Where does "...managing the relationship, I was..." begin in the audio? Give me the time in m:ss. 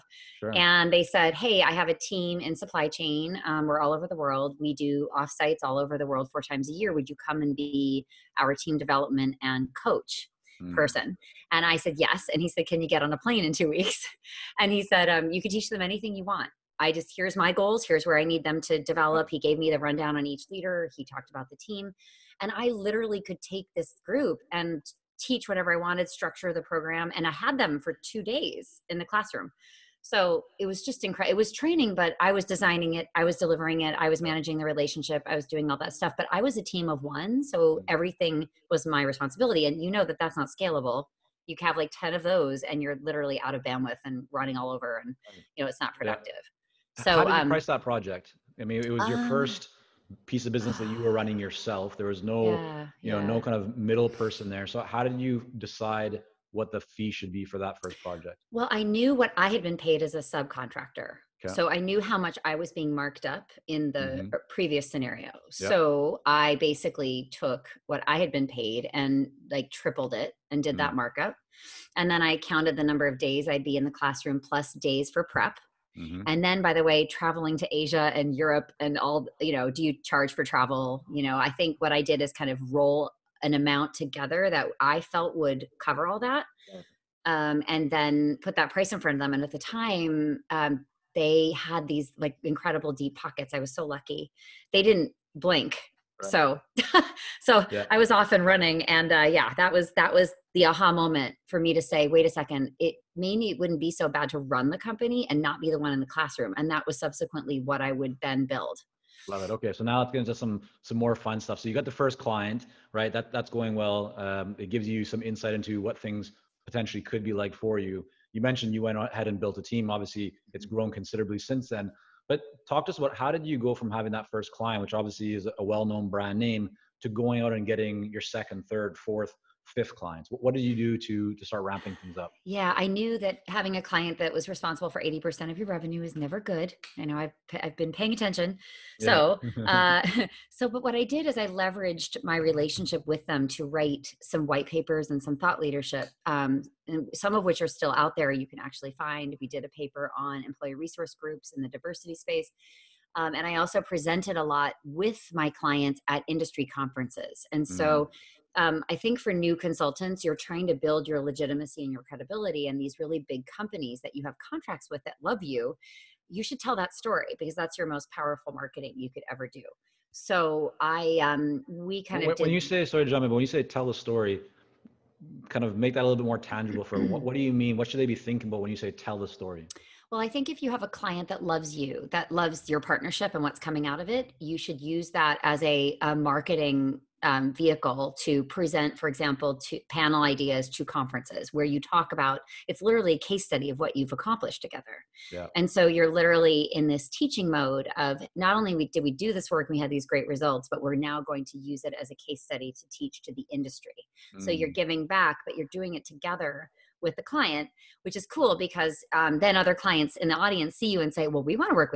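0:34.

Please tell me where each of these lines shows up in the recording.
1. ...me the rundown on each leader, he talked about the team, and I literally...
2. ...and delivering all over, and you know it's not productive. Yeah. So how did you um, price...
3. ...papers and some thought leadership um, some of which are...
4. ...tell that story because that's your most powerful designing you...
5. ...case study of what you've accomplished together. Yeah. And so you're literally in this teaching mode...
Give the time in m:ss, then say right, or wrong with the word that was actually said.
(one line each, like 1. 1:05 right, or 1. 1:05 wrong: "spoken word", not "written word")
1. 0:19 right
2. 0:44 wrong: "running", not "delivering"
3. 2:24 right
4. 2:46 wrong: "marketing", not "designing"
5. 3:13 right.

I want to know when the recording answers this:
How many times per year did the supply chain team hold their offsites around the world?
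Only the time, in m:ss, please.
0:06.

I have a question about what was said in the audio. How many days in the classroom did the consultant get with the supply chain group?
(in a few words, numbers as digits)
2.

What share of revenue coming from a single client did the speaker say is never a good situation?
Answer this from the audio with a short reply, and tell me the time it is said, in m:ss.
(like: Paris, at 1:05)
80%, at 2:15.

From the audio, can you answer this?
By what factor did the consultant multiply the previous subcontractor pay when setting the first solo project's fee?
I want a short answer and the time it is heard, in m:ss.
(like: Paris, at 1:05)
tripled, at 1:09.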